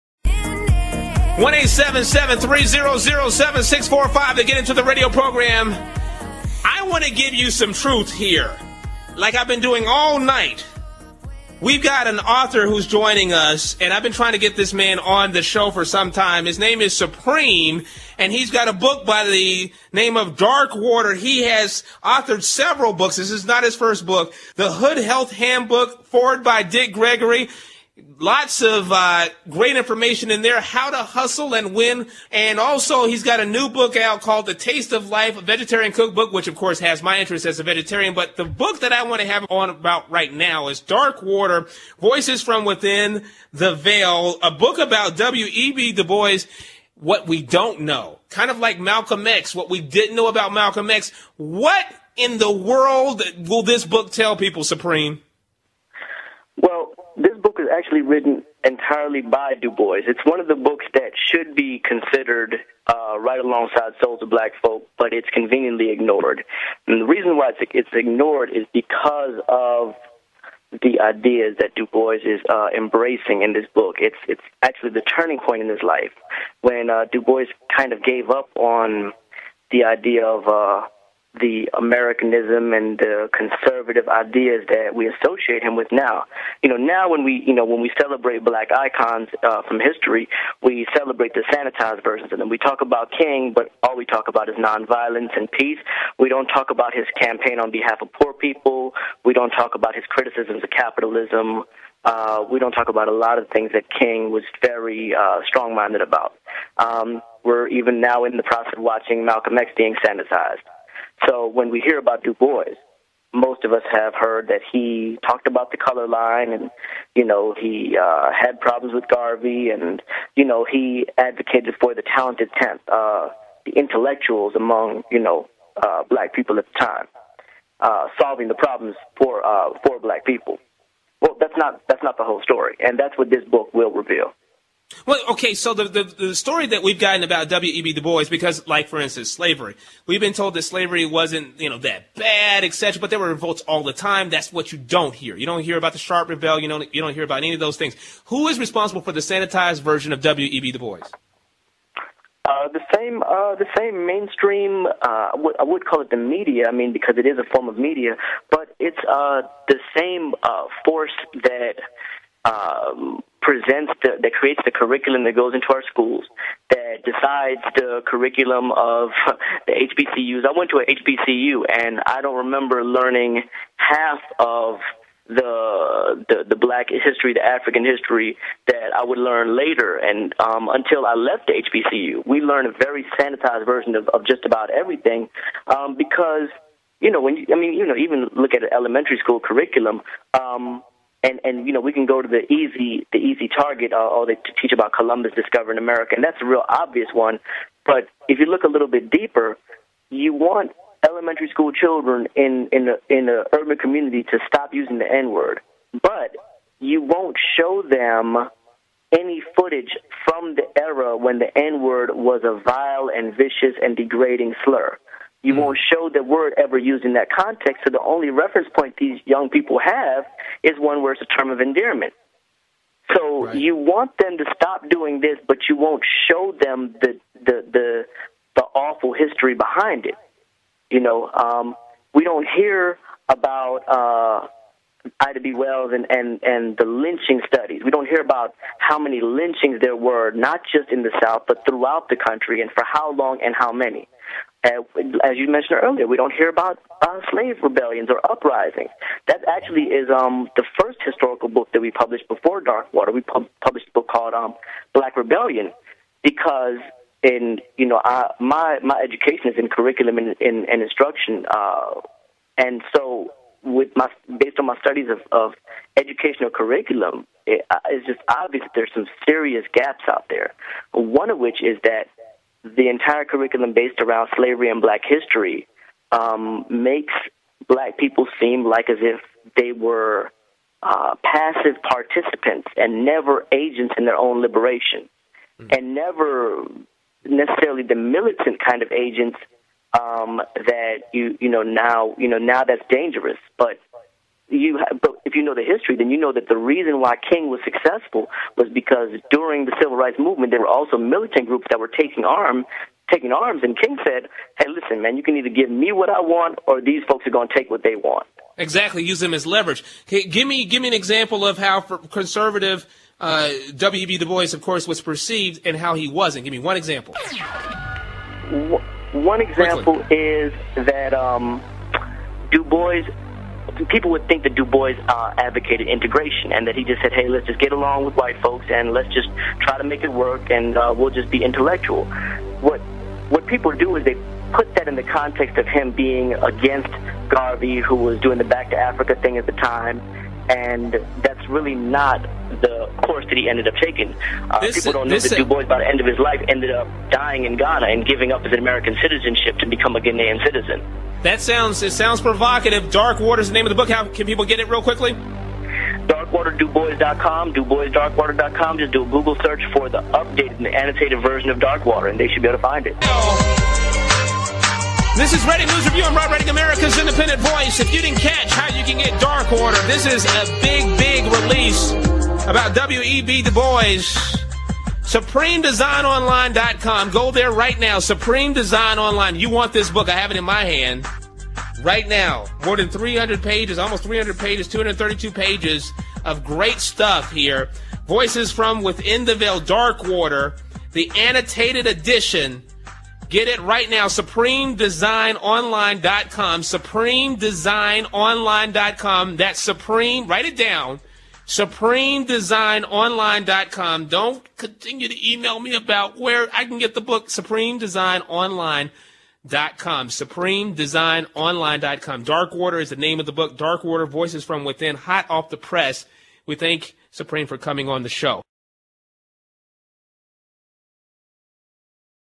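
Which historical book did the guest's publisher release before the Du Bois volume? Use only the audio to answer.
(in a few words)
Black Rebellion.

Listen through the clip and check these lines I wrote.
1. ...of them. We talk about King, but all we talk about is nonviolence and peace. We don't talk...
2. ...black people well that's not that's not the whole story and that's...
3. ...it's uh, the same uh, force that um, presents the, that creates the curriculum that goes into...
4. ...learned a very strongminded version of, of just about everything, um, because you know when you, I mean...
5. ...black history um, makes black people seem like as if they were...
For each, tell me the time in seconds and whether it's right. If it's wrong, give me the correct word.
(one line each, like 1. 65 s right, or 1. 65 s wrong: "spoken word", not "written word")
1. 92 s right
2. 129 s right
3. 158 s right
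4. 182 s wrong: "sanitized", not "strongminded"
5. 274 s right.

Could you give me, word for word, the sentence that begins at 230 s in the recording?
You know, um, we don't hear about uh, Ida B.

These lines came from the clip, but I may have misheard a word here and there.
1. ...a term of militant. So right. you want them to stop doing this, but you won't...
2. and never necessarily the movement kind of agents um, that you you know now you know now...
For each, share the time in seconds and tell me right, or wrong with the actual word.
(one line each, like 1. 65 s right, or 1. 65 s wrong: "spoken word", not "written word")
1. 221 s wrong: "endearment", not "militant"
2. 285 s wrong: "militant", not "movement".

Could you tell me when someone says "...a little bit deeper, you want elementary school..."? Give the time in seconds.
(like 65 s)
198 s.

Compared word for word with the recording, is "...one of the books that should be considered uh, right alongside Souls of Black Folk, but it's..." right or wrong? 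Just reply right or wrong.
right.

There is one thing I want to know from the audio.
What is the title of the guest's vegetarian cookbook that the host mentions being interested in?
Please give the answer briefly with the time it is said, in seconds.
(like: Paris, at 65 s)
The Taste of Life, at 34 s.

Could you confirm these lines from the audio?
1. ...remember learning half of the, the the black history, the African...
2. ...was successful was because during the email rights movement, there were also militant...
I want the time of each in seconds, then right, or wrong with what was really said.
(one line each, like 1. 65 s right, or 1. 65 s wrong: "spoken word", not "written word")
1. 172 s right
2. 297 s wrong: "civil", not "email".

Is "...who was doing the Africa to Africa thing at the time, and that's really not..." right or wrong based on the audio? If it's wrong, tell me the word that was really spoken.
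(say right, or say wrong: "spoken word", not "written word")
wrong: "Back", not "Africa".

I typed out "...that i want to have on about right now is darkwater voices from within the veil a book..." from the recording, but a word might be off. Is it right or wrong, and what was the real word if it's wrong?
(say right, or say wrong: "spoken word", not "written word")
right.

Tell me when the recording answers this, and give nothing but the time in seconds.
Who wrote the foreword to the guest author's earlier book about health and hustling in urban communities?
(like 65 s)
26 s.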